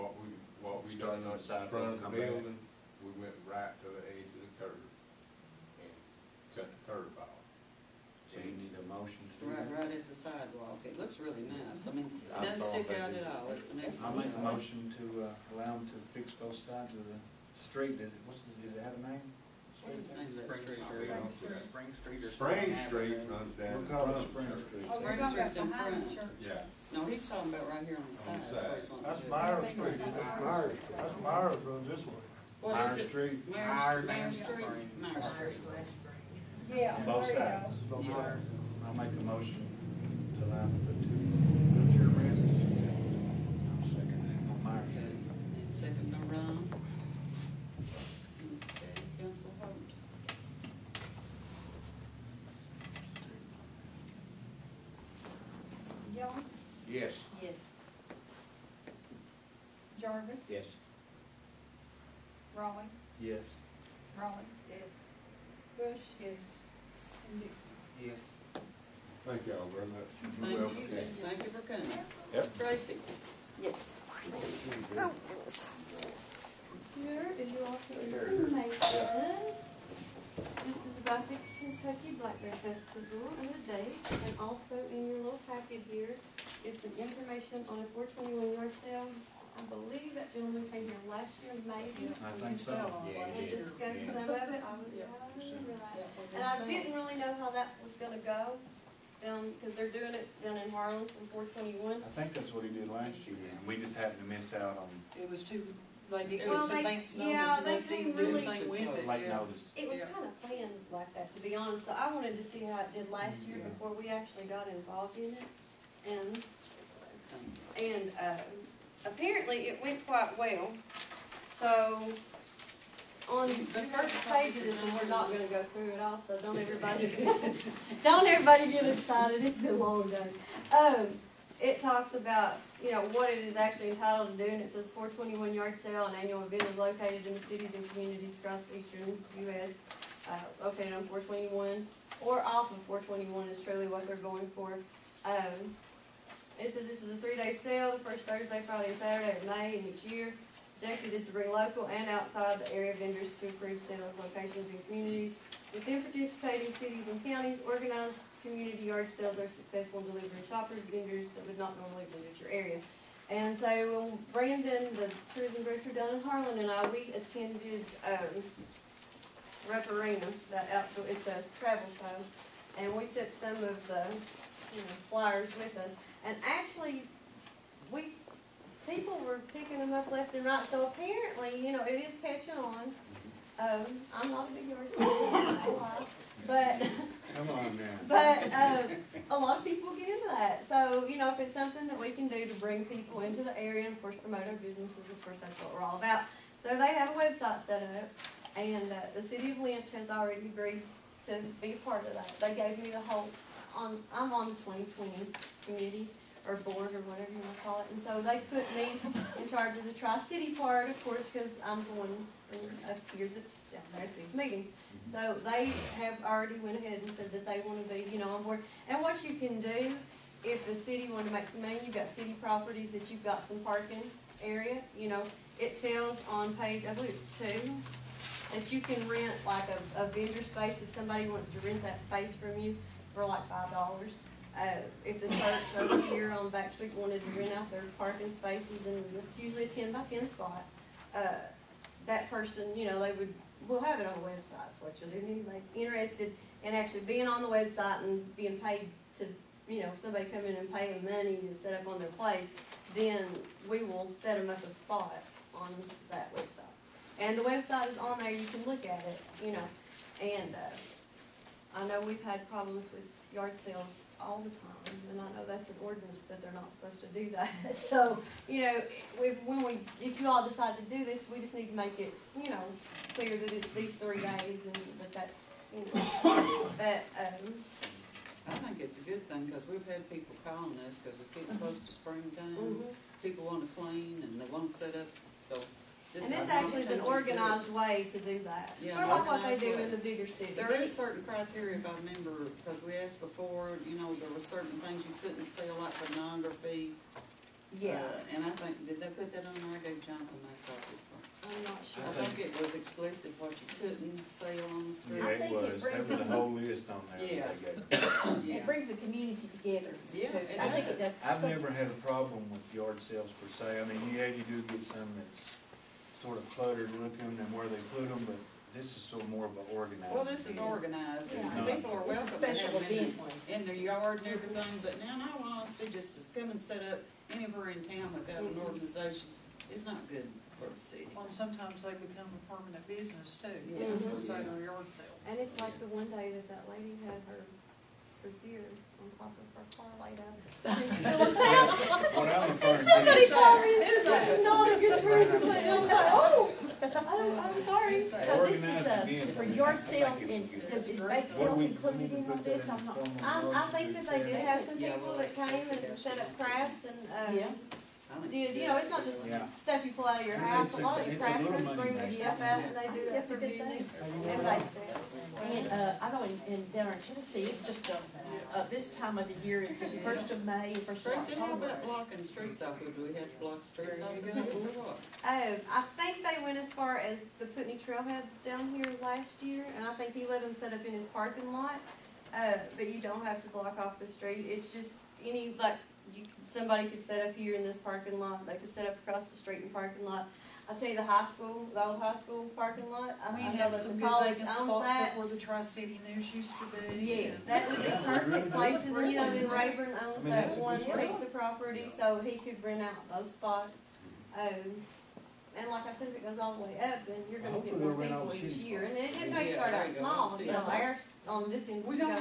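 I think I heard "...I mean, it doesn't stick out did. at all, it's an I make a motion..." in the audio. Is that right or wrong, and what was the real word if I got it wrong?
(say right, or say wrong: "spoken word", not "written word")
right.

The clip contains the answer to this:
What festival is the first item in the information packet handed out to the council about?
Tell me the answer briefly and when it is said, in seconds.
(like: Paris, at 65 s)
Kentucky Black Bear Festival, at 81 s.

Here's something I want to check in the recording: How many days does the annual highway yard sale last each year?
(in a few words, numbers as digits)
3.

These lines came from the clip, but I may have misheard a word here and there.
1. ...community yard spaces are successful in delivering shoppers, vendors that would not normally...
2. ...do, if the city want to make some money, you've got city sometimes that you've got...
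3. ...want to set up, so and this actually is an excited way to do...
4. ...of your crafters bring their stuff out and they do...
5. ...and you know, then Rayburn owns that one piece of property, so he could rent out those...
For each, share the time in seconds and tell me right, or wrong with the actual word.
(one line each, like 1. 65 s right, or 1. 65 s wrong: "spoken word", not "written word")
1. 158 s wrong: "sales", not "spaces"
2. 219 s wrong: "properties", not "sometimes"
3. 284 s wrong: "organized", not "excited"
4. 360 s right
5. 398 s right.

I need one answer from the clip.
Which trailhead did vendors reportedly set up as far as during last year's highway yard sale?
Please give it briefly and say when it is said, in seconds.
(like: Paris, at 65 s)
Putney Trailhead, at 377 s.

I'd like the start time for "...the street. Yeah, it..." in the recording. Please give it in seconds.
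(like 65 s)
304 s.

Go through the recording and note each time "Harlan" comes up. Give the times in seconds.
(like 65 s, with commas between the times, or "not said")
100 s, 166 s.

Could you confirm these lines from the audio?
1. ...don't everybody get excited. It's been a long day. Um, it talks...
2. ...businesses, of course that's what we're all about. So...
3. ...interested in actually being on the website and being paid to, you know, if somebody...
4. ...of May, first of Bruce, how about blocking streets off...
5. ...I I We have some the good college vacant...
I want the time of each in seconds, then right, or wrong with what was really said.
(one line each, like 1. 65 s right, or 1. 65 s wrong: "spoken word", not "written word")
1. 128 s right
2. 194 s right
3. 245 s right
4. 370 s right
5. 393 s right.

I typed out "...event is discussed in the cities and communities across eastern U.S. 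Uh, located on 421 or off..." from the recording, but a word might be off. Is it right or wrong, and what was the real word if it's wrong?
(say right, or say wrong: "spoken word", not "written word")
wrong: "located", not "discussed".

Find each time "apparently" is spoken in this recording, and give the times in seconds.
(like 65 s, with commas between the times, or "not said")
119 s, 180 s.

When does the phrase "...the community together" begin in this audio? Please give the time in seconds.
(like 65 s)
308 s.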